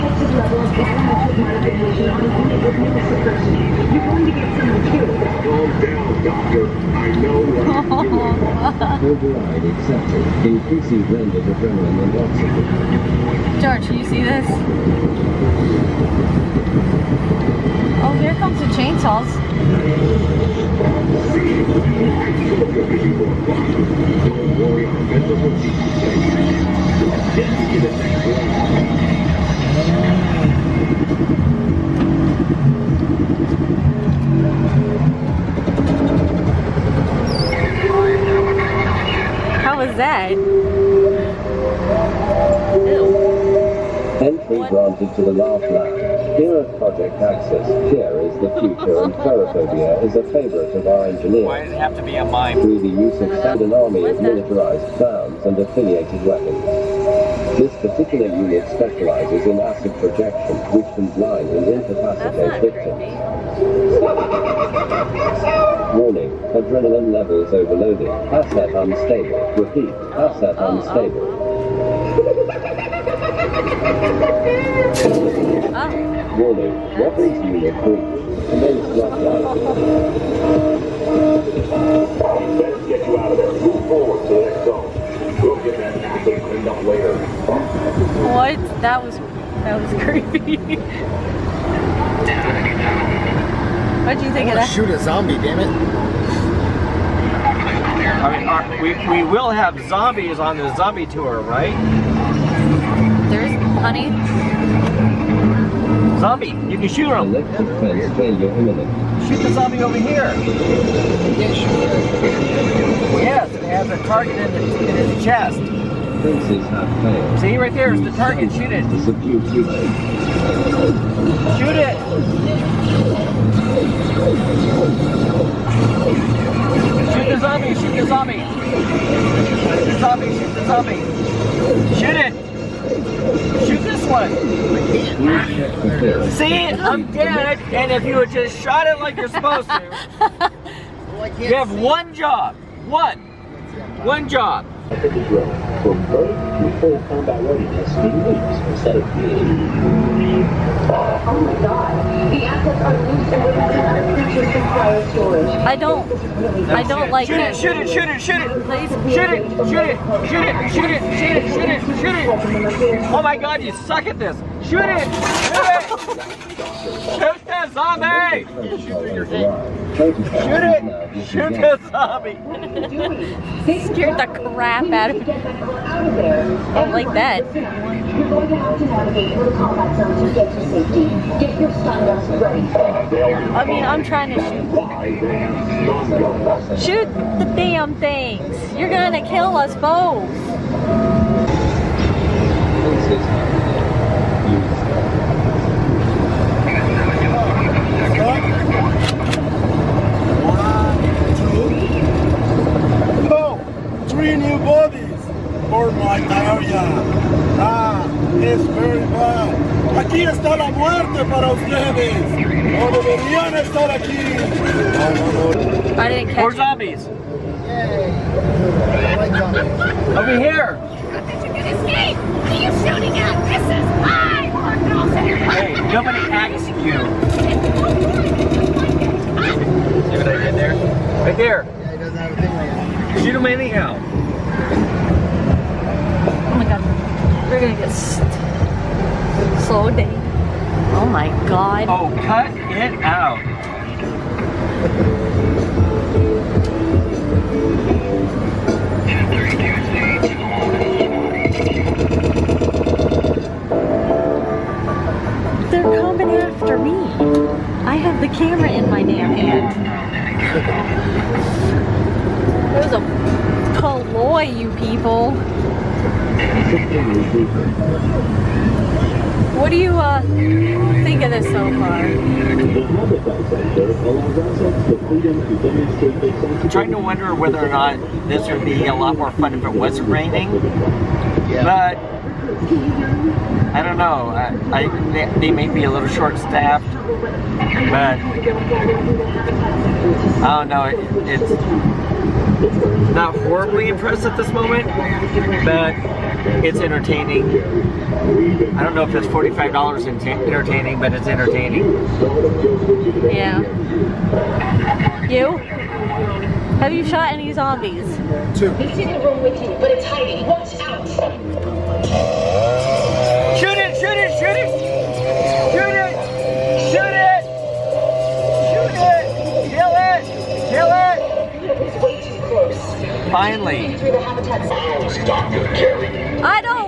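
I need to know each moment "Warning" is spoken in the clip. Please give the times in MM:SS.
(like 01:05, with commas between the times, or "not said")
01:05, 01:16.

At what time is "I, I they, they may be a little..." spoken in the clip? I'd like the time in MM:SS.
04:44.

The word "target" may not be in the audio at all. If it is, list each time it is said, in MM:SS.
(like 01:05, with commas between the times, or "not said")
01:54, 01:58.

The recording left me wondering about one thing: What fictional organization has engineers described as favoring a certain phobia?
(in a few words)
Project Access.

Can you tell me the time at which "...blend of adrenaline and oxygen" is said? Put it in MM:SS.
00:11.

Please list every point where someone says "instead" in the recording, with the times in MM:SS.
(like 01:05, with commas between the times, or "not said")
02:28.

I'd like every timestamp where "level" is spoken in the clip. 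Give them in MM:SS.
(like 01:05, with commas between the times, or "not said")
00:00, 01:07.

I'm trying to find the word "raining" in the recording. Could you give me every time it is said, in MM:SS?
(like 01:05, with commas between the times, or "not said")
04:40.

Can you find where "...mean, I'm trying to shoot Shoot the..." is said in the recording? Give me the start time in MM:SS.
03:03.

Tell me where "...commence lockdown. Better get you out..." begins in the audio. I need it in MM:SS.
01:18.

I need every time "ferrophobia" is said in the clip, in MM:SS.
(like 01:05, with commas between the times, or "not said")
00:49.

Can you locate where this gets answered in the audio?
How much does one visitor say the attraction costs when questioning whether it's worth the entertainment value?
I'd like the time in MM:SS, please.
04:59.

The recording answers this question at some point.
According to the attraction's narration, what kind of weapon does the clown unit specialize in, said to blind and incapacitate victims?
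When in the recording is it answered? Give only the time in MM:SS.
00:59.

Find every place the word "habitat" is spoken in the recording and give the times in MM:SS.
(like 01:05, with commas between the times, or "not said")
05:24.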